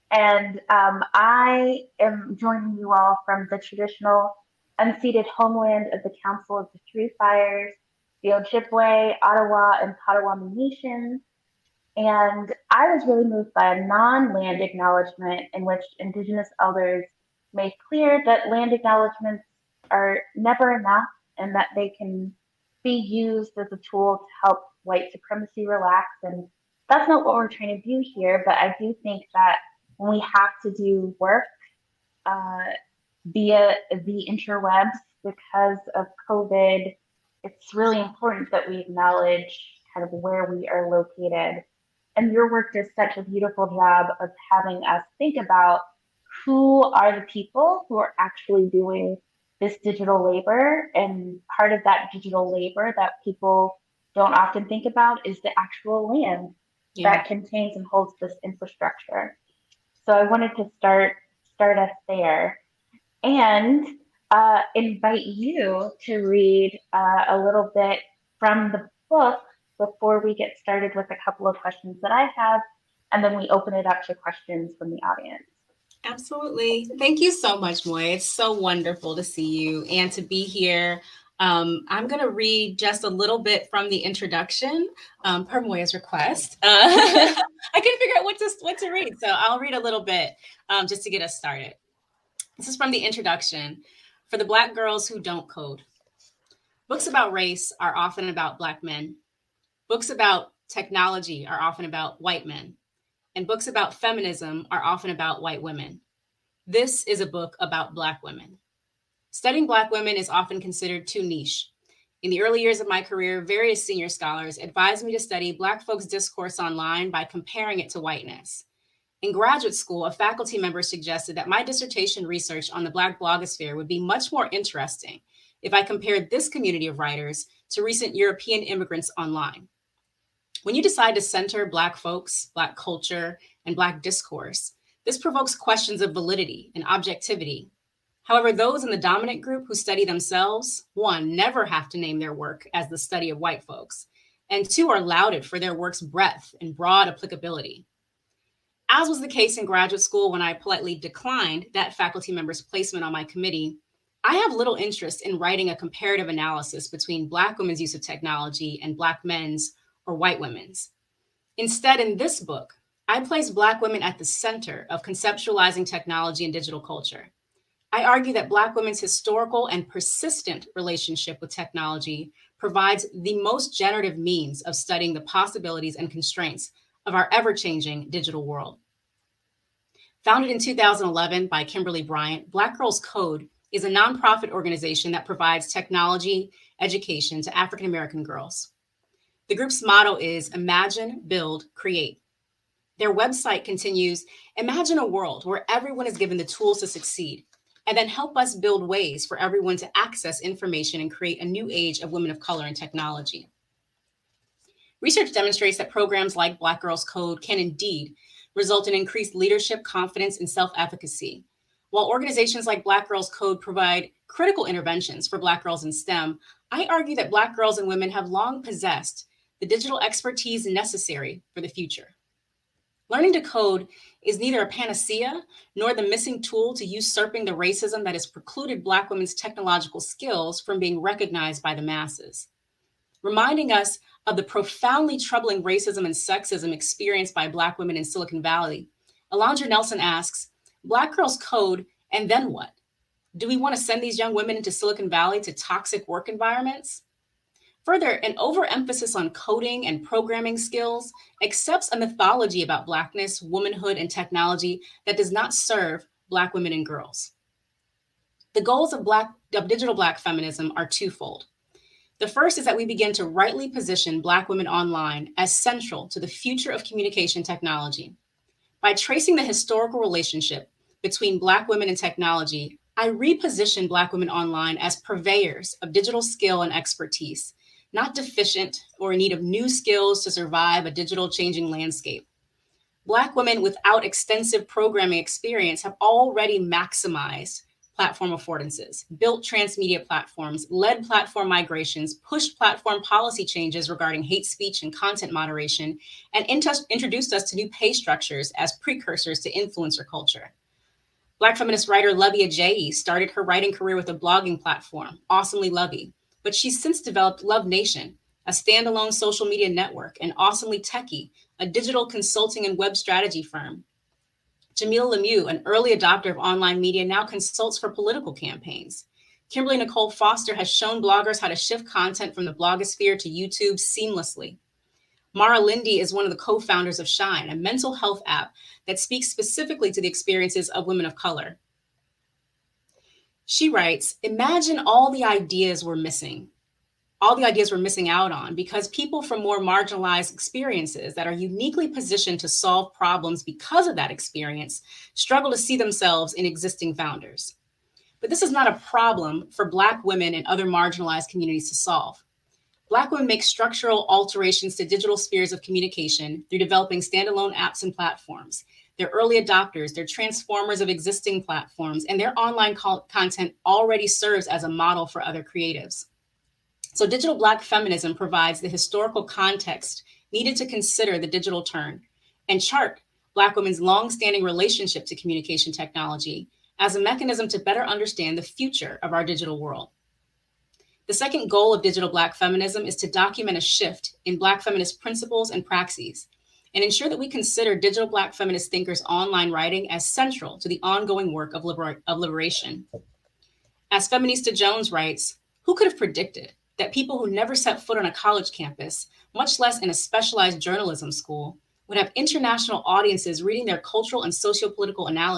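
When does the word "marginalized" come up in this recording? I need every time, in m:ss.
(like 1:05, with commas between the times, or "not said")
5:39, 5:50.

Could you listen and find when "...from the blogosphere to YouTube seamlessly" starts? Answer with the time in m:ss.
5:22.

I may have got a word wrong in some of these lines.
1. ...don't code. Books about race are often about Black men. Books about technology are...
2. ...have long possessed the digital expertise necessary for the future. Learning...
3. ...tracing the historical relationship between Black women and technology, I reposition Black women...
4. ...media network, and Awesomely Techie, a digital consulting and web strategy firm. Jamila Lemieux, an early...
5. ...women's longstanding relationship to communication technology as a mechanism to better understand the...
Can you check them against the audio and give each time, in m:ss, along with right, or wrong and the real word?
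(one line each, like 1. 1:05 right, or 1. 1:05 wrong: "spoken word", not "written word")
1. 1:35 right
2. 3:38 right
3. 4:28 right
4. 5:09 right
5. 6:13 right.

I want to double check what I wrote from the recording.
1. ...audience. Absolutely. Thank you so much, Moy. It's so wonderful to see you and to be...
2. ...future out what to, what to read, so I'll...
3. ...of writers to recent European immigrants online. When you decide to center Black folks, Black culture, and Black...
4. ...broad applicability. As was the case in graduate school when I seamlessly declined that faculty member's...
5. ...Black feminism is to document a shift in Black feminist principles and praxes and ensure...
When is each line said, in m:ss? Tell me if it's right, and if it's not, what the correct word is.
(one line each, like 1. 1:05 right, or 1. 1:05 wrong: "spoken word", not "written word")
1. 1:15 right
2. 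1:27 wrong: "figure", not "future"
3. 2:06 right
4. 2:26 wrong: "politely", not "seamlessly"
5. 6:22 right.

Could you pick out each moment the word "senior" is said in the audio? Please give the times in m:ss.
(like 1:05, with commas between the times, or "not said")
1:53.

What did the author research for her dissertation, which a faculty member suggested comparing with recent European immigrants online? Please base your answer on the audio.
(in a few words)
The Black blogosphere.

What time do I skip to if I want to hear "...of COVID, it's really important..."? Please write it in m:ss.
0:35.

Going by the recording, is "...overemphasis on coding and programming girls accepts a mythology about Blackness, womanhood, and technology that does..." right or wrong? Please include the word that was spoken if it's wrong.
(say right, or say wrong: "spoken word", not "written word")
wrong: "skills", not "girls".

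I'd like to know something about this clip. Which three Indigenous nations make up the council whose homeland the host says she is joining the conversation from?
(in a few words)
Ojibwe, Ottawa, and Potawatomi.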